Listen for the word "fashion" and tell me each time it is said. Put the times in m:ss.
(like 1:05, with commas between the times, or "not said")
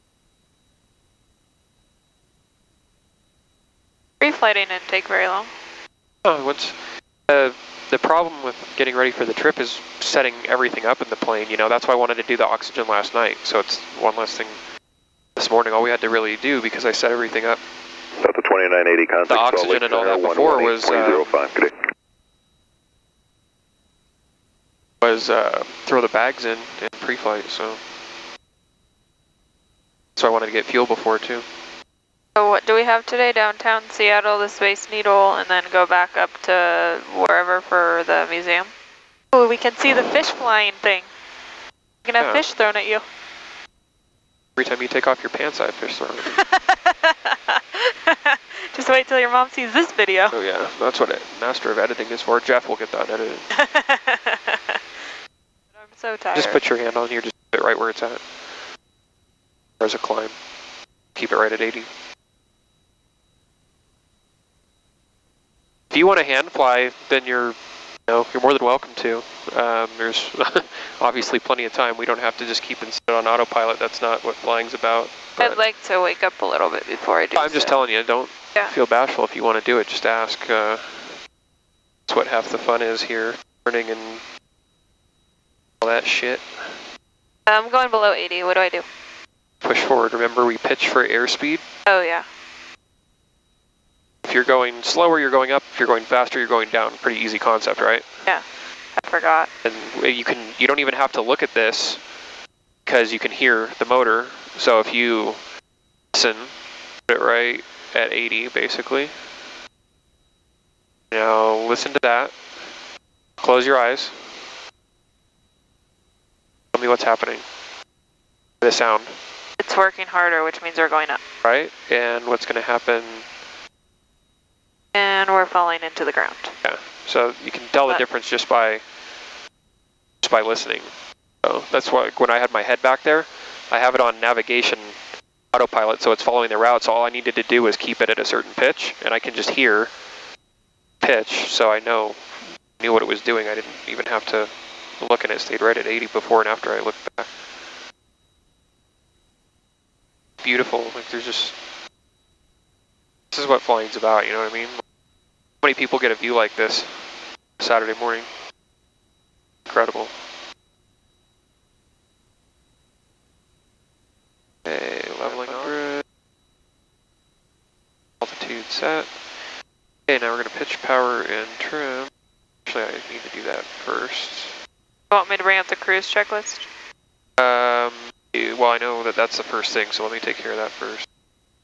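not said.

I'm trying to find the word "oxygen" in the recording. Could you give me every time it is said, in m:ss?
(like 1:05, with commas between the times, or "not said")
0:12, 0:19.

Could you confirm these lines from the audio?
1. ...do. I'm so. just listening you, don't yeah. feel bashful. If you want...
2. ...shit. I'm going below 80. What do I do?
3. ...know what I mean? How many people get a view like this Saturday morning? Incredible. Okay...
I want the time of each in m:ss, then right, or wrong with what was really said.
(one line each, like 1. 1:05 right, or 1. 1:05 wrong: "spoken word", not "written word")
1. 1:17 wrong: "telling", not "listening"
2. 1:26 right
3. 2:34 right.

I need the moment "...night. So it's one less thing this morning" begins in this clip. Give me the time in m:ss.
0:13.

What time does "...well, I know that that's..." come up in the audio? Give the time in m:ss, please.
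2:58.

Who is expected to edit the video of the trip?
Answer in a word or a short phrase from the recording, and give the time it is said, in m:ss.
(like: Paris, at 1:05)
Jeff, at 0:52.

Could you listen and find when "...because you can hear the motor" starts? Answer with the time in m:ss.
1:42.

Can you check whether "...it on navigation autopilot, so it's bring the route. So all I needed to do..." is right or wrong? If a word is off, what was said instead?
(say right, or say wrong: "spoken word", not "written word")
wrong: "following", not "bring".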